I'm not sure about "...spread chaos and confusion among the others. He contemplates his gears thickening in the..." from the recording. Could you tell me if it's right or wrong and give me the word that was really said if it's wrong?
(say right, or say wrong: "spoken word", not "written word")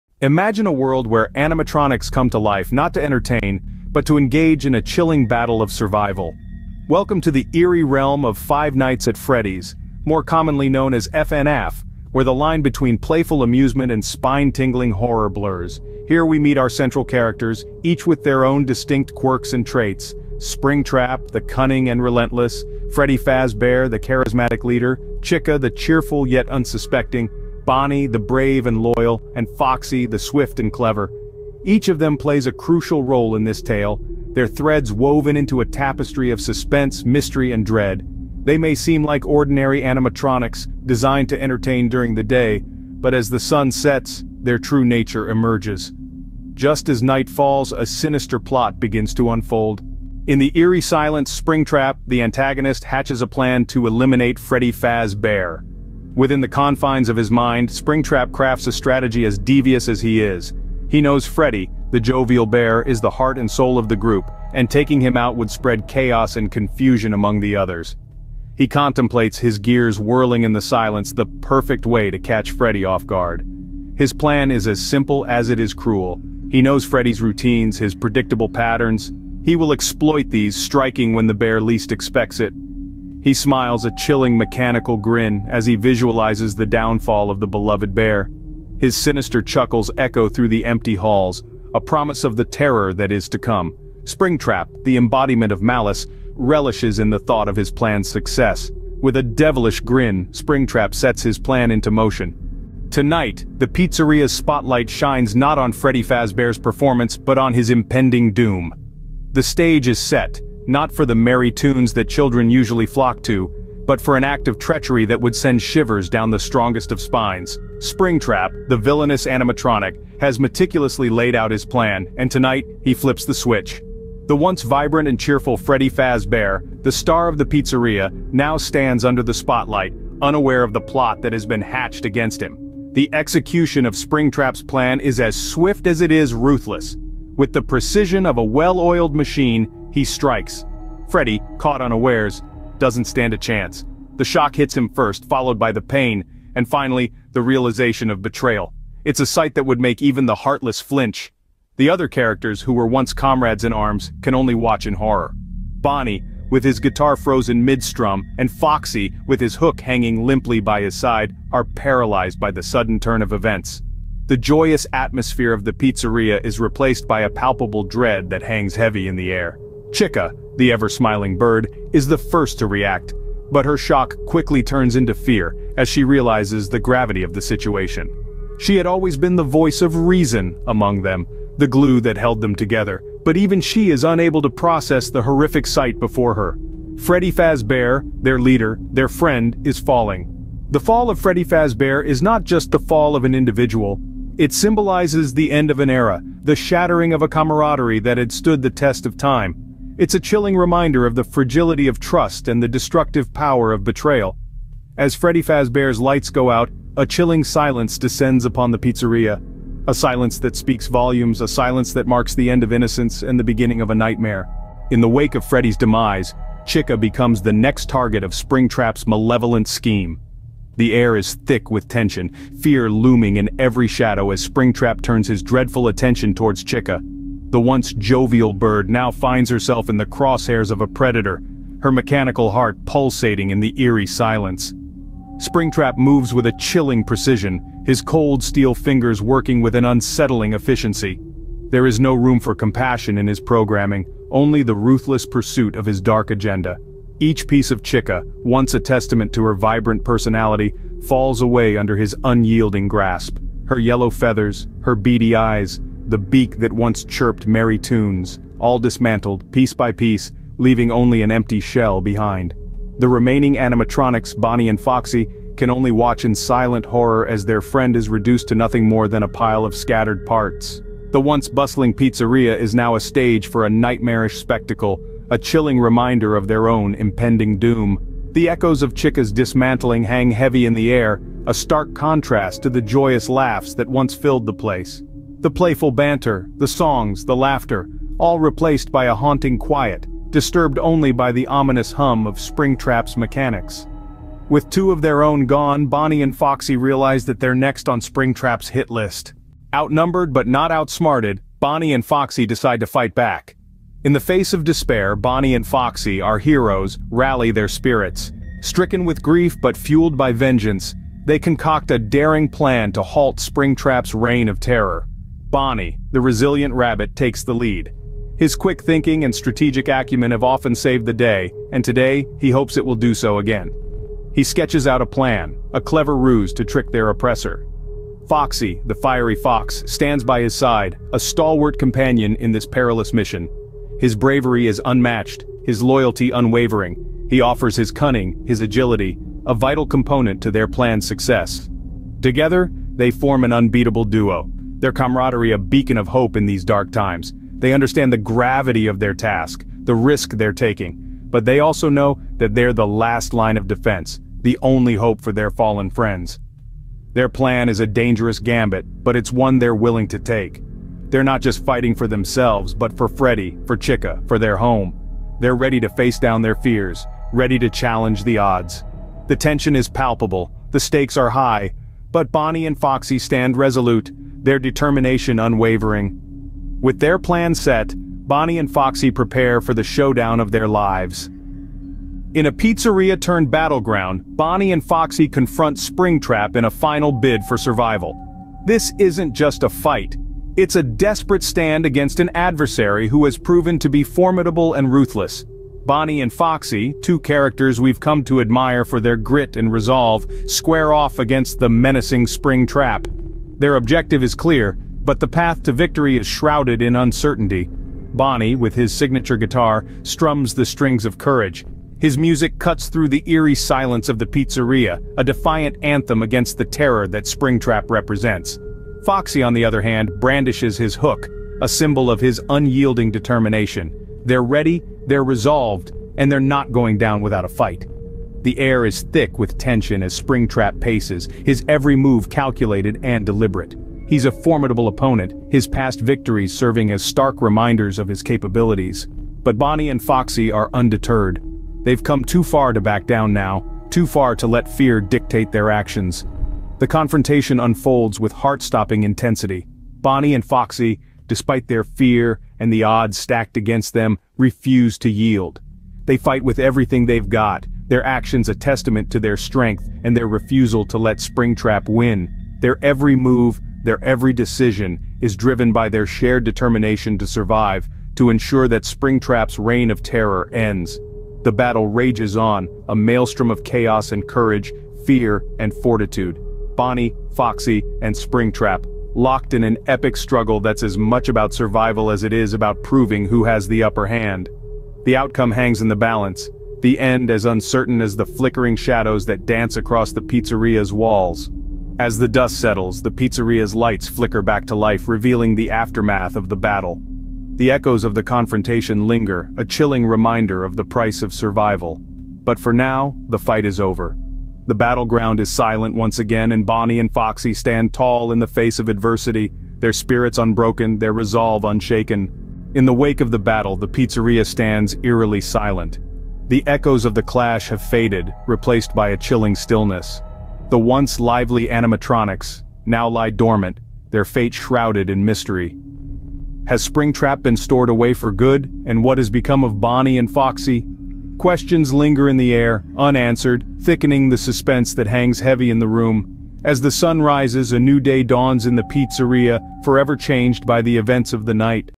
wrong: "whirling", not "thickening".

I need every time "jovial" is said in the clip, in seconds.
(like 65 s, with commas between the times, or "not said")
62 s, 227 s.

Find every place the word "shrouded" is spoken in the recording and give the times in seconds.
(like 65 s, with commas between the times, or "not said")
406 s, 524 s.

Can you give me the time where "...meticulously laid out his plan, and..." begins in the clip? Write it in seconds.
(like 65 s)
120 s.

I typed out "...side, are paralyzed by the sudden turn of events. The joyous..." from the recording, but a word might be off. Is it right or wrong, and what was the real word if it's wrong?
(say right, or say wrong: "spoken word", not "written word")
right.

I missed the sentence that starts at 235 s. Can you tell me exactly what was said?
Springtrap moves with a chilling precision, his cold steel fingers working with an unsettling efficiency.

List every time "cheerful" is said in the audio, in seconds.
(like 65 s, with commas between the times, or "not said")
25 s, 125 s.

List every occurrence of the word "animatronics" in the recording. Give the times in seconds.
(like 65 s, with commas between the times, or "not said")
1 s, 39 s, 119 s, 263 s, 521 s.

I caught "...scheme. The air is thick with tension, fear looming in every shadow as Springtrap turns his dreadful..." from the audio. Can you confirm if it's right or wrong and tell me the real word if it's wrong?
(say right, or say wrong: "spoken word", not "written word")
right.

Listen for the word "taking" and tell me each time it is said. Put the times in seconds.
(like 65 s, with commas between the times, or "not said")
64 s, 350 s.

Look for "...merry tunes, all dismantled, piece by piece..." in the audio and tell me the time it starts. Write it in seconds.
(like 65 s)
257 s.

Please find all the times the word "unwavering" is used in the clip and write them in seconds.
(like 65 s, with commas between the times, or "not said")
336 s, 375 s.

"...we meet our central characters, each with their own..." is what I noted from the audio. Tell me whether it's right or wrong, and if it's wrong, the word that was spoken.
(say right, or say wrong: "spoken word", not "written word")
right.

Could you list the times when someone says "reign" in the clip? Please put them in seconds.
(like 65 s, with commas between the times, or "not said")
314 s, 469 s.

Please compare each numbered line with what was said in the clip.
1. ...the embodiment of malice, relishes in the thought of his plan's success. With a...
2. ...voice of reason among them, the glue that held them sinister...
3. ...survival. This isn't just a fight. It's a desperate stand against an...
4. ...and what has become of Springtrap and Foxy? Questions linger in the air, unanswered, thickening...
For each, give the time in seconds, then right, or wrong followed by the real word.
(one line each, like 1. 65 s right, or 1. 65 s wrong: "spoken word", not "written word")
1. 94 s right
2. 179 s wrong: "together", not "sinister"
3. 387 s right
4. 528 s wrong: "Bonnie", not "Springtrap".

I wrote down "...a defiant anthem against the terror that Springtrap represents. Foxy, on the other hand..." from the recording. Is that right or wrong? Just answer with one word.
right.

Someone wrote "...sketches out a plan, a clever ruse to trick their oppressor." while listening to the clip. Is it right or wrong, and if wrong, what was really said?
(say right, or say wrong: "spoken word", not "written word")
right.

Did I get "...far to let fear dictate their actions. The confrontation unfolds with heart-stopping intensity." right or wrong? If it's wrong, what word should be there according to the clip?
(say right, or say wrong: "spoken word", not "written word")
right.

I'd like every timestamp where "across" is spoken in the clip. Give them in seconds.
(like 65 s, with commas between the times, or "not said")
489 s.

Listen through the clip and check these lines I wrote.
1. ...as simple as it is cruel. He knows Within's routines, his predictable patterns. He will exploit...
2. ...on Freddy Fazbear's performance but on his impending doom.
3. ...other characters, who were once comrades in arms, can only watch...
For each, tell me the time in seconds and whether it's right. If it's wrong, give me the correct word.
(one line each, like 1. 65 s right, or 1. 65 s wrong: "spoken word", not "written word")
1. 74 s wrong: "Freddy", not "Within"
2. 105 s right
3. 151 s right.